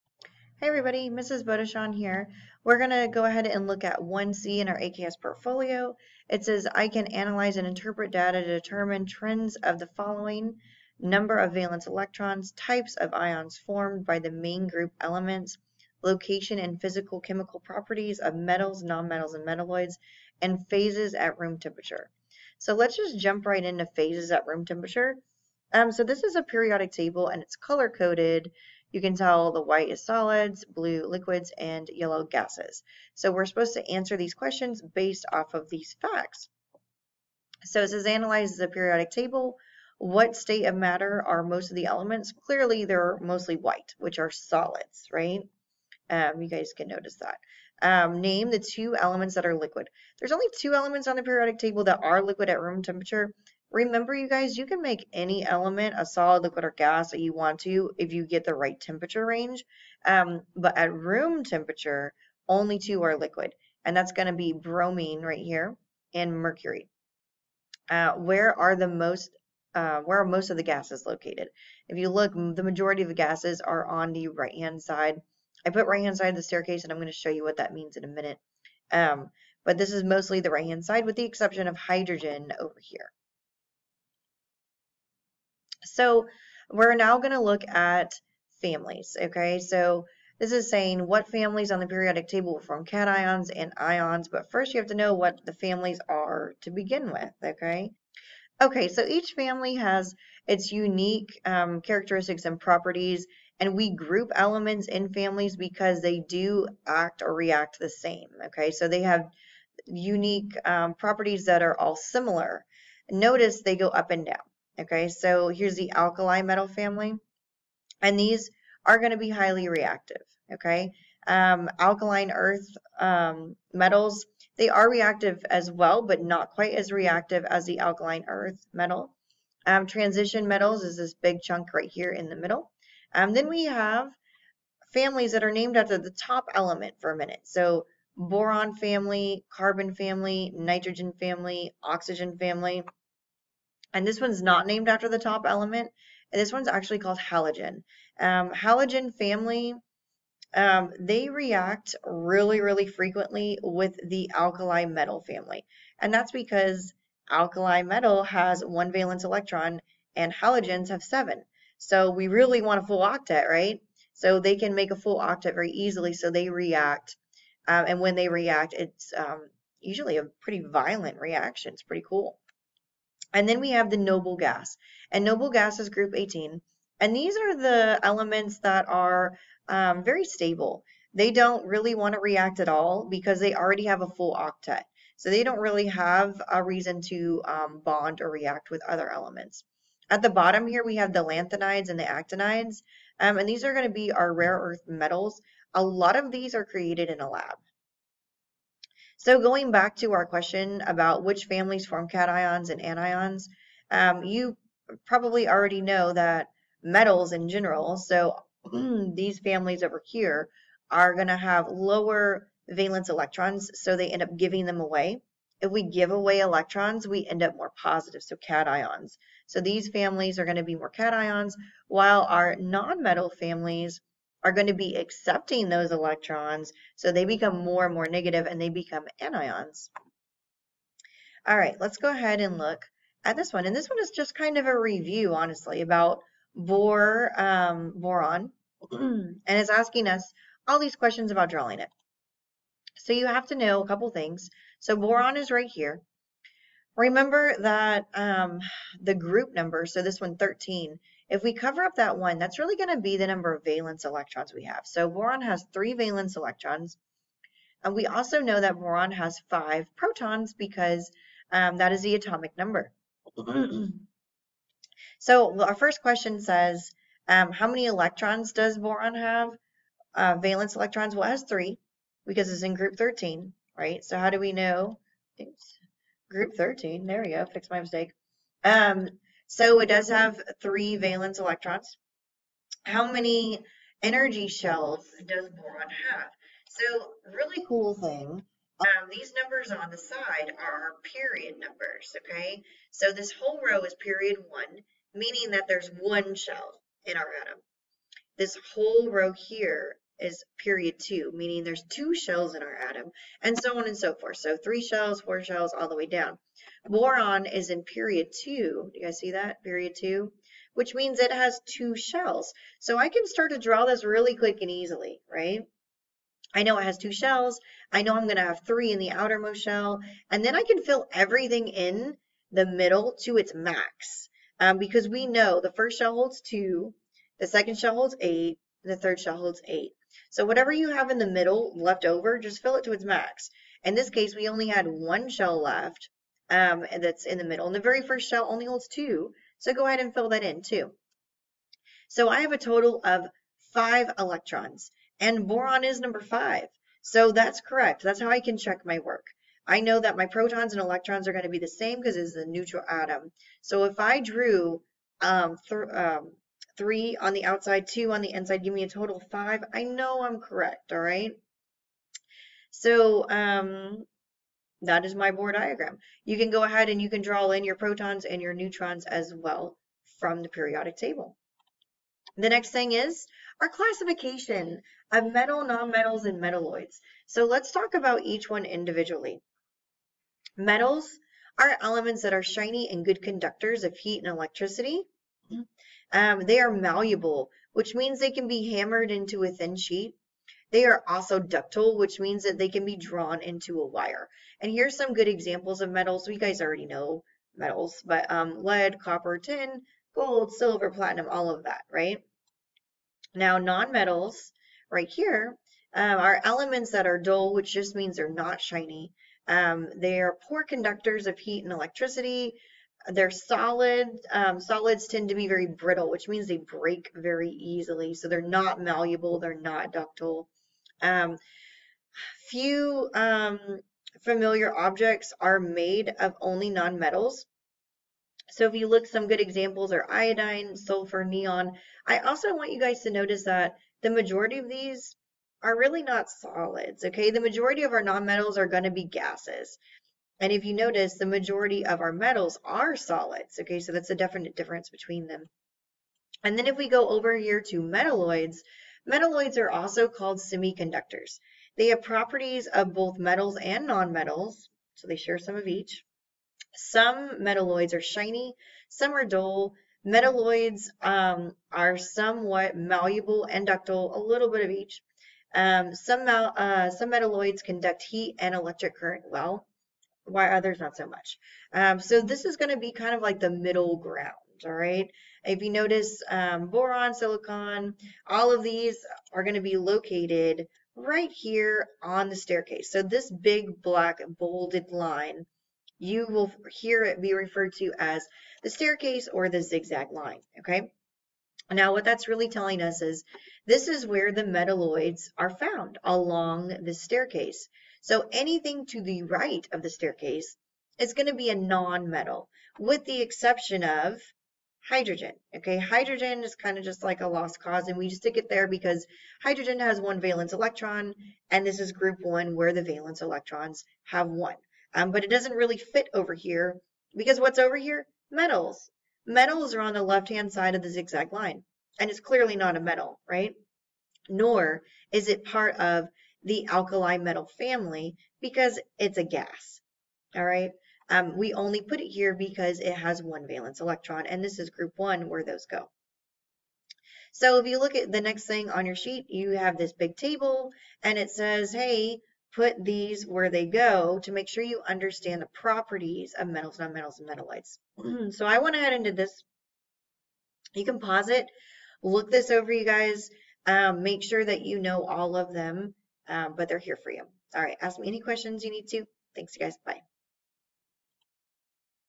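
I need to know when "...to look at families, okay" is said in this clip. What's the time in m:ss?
1:27.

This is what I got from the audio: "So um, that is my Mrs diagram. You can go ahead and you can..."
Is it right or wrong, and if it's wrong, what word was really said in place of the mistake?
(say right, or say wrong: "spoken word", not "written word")
wrong: "Bohr", not "Mrs".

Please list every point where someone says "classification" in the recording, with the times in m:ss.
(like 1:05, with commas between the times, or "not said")
6:13.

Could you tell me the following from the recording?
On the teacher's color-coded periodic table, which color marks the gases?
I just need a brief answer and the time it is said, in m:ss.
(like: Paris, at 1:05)
Yellow, at 0:31.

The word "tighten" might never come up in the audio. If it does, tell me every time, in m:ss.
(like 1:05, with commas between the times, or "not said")
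not said.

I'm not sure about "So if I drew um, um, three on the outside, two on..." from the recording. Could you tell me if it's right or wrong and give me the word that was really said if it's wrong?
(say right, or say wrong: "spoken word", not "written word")
right.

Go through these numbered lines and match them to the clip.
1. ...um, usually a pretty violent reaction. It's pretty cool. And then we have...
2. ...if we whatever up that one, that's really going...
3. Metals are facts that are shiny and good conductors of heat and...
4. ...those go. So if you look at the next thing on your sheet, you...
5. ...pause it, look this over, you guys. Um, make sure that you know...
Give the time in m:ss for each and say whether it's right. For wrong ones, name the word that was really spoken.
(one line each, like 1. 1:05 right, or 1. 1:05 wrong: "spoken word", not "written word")
1. 2:49 right
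2. 4:11 wrong: "cover", not "whatever"
3. 6:20 wrong: "elements", not "facts"
4. 8:55 right
5. 9:10 right.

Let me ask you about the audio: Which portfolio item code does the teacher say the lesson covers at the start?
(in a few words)
1C.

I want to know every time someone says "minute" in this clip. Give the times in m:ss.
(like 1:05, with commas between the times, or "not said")
1:18, 2:17.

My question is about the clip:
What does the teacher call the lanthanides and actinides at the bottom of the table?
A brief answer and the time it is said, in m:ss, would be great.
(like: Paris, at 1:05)
Rare earth metals, at 3:14.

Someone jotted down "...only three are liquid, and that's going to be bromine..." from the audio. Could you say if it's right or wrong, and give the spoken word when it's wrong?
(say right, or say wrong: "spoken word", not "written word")
wrong: "two", not "three".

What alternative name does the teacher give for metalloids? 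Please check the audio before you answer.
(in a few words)
Semiconductors.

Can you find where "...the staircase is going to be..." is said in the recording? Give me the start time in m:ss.
8:19.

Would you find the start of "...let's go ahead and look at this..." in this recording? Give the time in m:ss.
3:51.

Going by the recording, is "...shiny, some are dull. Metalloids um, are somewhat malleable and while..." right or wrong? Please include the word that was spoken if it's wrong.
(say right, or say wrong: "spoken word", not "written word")
wrong: "ductile", not "while".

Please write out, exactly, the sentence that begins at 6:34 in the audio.
And here's some good examples of metals.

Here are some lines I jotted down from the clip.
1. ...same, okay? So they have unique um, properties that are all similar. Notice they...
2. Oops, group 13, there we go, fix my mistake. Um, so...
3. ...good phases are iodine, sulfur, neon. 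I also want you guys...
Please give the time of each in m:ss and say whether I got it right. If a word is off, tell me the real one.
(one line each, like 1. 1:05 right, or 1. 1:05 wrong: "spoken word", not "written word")
1. 1:47 right
2. 4:35 right
3. 7:09 wrong: "examples", not "phases".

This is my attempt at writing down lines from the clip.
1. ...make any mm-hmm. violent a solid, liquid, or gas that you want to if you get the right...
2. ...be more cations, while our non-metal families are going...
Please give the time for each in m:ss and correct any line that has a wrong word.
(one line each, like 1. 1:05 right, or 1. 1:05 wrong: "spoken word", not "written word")
1. 0:54 wrong: "element", not "violent"
2. 3:40 right.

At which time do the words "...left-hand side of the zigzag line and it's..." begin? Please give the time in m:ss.
8:40.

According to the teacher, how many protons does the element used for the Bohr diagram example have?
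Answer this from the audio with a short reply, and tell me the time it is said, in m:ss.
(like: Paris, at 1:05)
5, at 4:19.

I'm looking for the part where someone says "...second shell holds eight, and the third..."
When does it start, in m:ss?
5:27.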